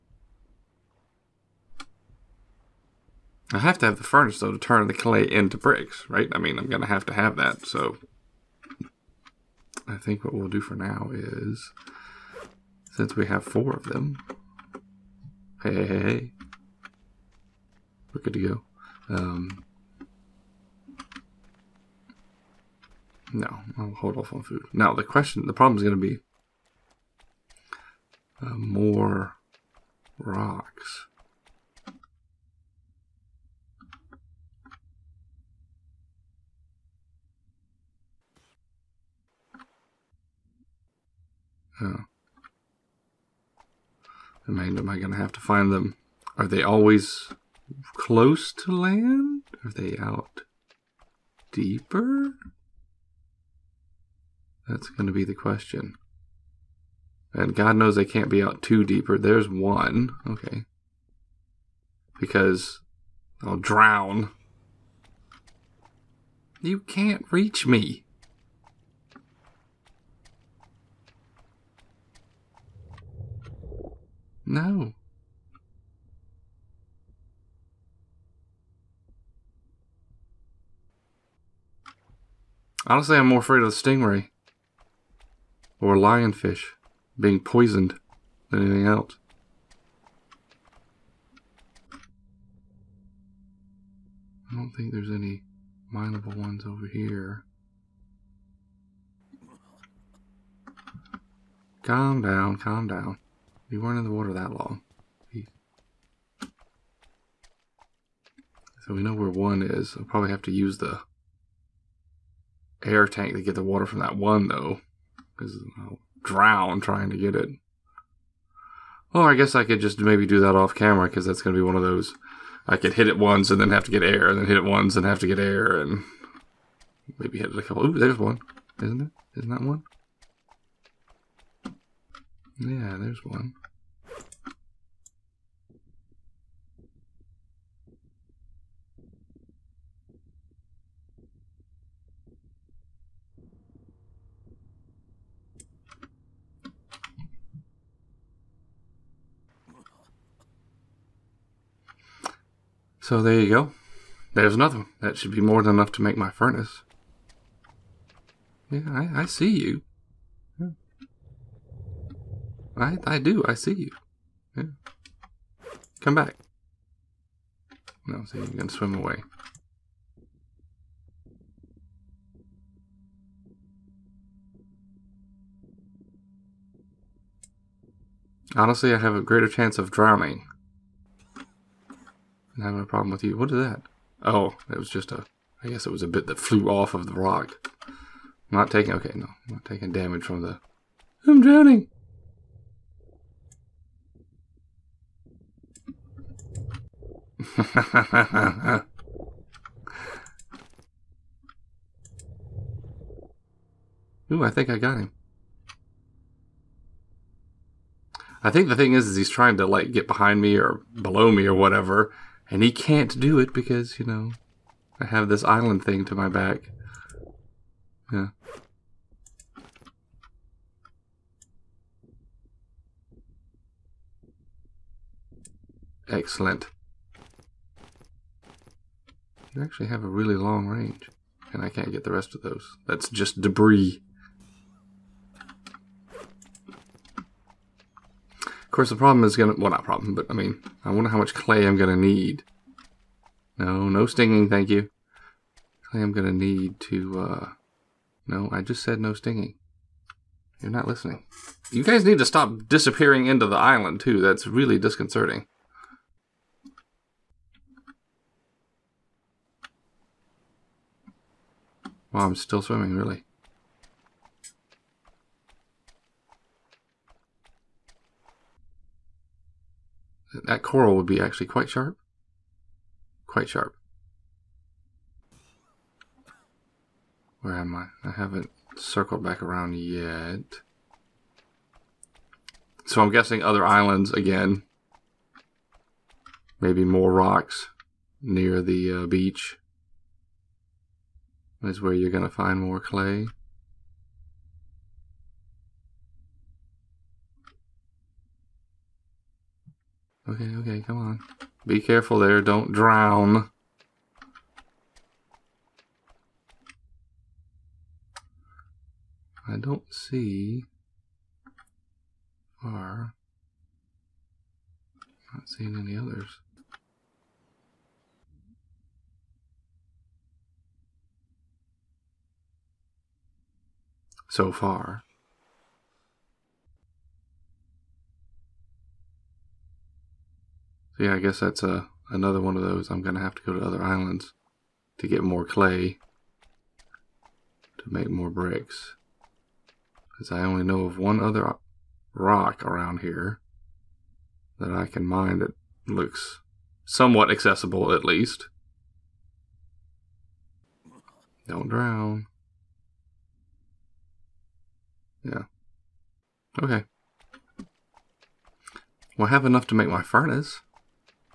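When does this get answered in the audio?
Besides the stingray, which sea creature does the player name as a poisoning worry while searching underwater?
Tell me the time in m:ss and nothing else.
1:25.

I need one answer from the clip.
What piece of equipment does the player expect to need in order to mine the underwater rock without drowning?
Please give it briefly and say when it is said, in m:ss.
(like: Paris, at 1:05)
air tank, at 1:52.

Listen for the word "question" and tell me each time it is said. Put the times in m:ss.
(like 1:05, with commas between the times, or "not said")
0:25, 0:55.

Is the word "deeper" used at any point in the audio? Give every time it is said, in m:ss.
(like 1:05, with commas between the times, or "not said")
0:51, 0:58.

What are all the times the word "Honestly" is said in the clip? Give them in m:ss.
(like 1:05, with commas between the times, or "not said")
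1:22, 2:58.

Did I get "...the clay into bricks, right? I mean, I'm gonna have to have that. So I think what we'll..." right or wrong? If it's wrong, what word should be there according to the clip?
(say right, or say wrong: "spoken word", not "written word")
right.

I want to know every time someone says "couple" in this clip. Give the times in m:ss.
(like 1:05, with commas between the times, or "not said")
2:07.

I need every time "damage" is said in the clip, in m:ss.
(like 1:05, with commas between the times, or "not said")
3:09.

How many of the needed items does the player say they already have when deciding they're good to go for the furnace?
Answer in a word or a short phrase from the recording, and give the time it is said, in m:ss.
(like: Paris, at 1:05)
4, at 0:13.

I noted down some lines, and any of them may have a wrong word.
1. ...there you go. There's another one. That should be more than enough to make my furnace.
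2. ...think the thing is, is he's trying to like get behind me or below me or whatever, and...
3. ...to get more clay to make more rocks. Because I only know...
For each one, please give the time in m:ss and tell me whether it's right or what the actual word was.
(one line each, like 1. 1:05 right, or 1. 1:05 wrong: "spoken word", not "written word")
1. 2:33 right
2. 3:28 right
3. 5:34 wrong: "bricks", not "rocks".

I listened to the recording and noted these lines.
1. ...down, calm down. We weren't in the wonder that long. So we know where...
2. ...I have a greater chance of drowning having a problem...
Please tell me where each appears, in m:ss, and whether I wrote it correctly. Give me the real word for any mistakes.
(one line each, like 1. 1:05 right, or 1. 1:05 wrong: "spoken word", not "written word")
1. 1:42 wrong: "water", not "wonder"
2. 2:58 right.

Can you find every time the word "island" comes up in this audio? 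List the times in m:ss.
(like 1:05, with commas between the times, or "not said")
3:35, 4:13, 4:43, 5:33.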